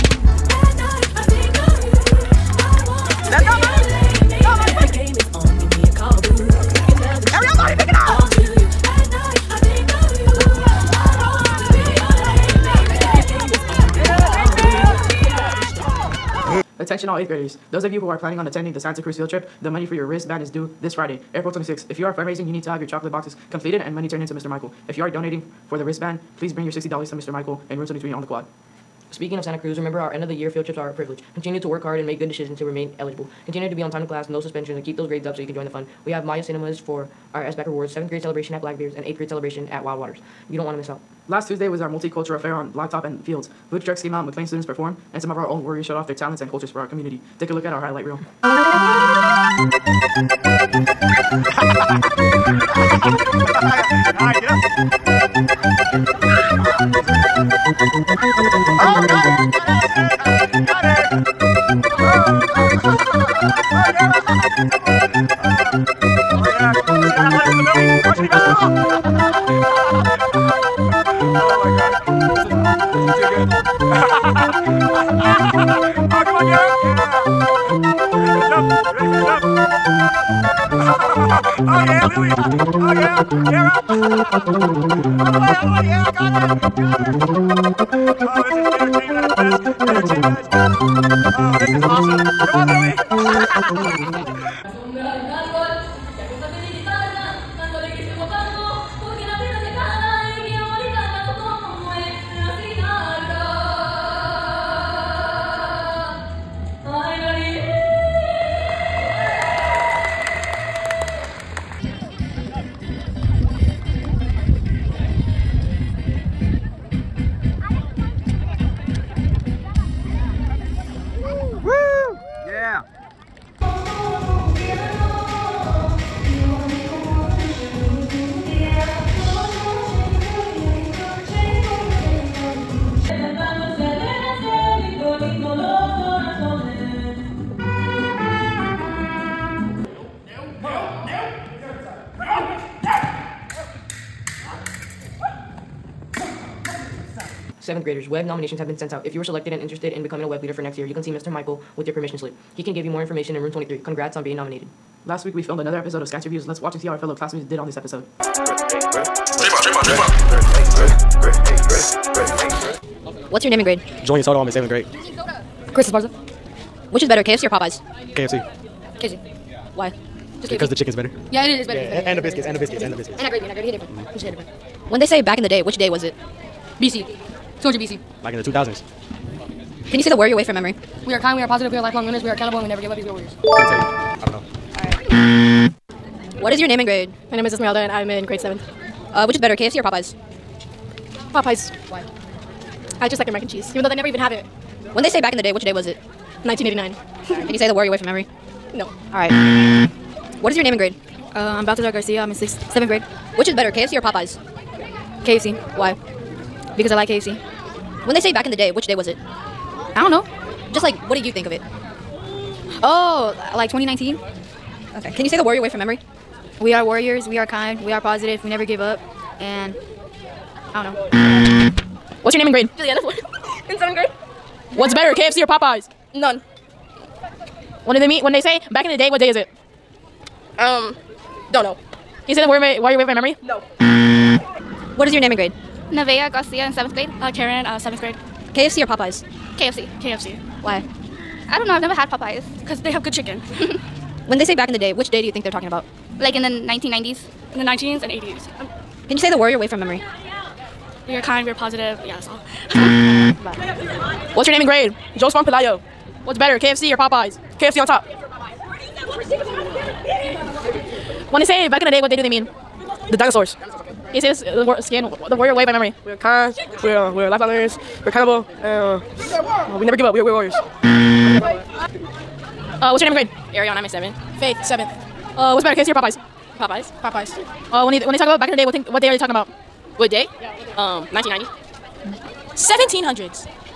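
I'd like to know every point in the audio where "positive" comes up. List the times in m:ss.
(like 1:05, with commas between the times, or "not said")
3:01, 3:37, 4:11.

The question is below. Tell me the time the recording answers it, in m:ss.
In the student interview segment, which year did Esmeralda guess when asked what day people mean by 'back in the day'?
3:16.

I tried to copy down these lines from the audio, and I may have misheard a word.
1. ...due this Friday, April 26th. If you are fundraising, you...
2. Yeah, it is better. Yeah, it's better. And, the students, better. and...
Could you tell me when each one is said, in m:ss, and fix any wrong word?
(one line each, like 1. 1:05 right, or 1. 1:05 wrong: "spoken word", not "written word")
1. 0:20 right
2. 2:51 wrong: "biscuits", not "students".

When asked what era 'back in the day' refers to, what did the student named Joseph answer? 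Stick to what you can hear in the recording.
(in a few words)
The dinosaurs.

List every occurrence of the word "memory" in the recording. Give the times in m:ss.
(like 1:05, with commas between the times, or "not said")
3:00, 3:18, 3:35, 3:53, 4:09, 4:25.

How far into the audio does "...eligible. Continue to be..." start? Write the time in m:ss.
0:32.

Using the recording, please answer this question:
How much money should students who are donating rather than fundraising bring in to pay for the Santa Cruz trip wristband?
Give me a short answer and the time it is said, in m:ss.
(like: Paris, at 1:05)
$60, at 0:26.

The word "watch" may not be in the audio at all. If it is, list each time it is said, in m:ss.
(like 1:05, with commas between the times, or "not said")
2:36.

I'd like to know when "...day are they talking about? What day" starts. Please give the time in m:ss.
4:39.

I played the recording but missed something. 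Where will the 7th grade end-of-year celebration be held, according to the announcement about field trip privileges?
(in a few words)
Blackbeard's.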